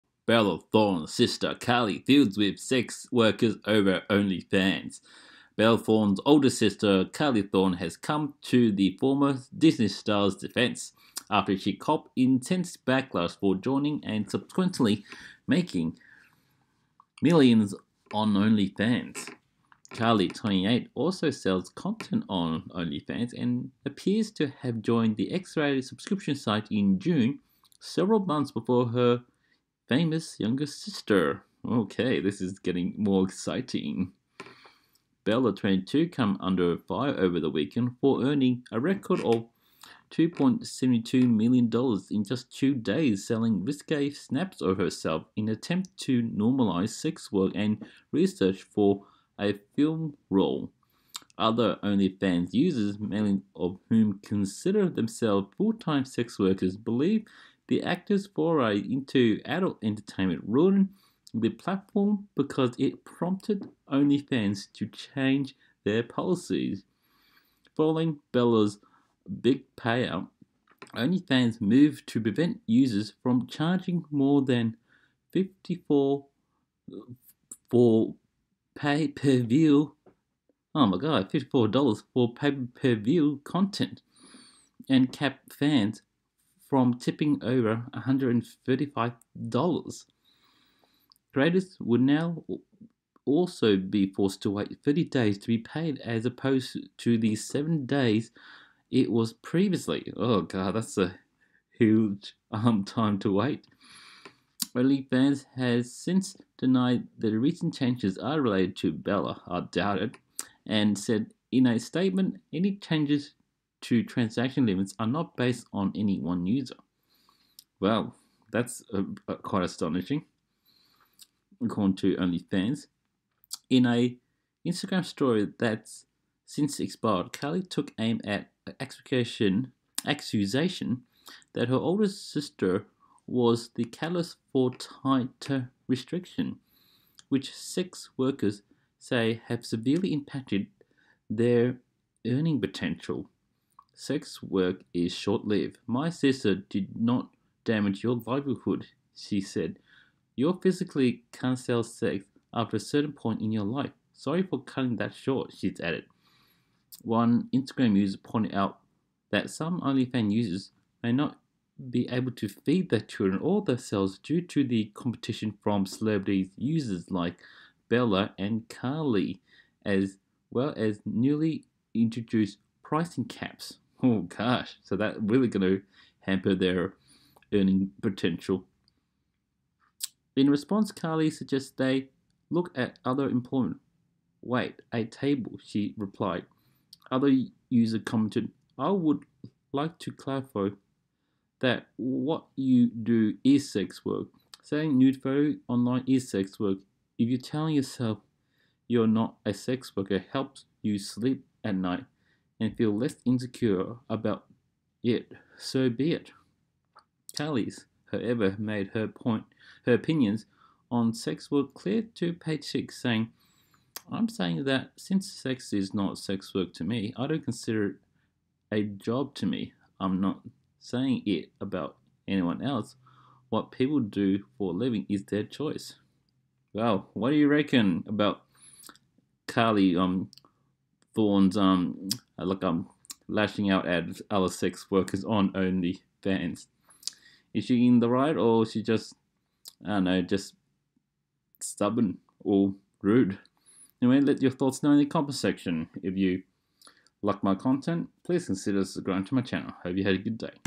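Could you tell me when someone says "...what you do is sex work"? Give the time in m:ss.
3:11.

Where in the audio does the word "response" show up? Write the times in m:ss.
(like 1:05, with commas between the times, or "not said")
3:00.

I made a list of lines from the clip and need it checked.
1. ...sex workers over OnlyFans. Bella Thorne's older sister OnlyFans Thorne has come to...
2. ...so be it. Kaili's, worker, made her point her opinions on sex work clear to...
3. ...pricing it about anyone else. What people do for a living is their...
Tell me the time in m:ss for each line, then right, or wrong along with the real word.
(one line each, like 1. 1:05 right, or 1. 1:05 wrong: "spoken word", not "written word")
1. 0:02 wrong: "Kaili", not "OnlyFans"
2. 3:25 wrong: "however", not "worker"
3. 3:40 wrong: "saying", not "pricing".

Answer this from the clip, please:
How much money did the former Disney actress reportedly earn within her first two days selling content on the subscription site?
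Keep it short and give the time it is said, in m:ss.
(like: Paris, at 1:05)
$2.72 million, at 0:40.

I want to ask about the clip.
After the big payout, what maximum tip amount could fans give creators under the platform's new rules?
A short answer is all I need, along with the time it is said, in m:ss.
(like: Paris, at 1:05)
$135, at 1:27.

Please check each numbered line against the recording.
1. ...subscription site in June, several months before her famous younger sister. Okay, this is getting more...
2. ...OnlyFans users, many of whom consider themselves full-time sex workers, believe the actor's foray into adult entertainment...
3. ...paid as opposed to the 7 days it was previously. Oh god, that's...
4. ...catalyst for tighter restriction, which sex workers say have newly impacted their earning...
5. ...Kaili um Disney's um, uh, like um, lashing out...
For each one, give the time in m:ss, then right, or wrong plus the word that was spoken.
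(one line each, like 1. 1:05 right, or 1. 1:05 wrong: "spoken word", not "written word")
1. 0:25 right
2. 0:51 right
3. 1:35 right
4. 2:13 wrong: "severely", not "newly"
5. 3:49 wrong: "Thorne", not "Disney".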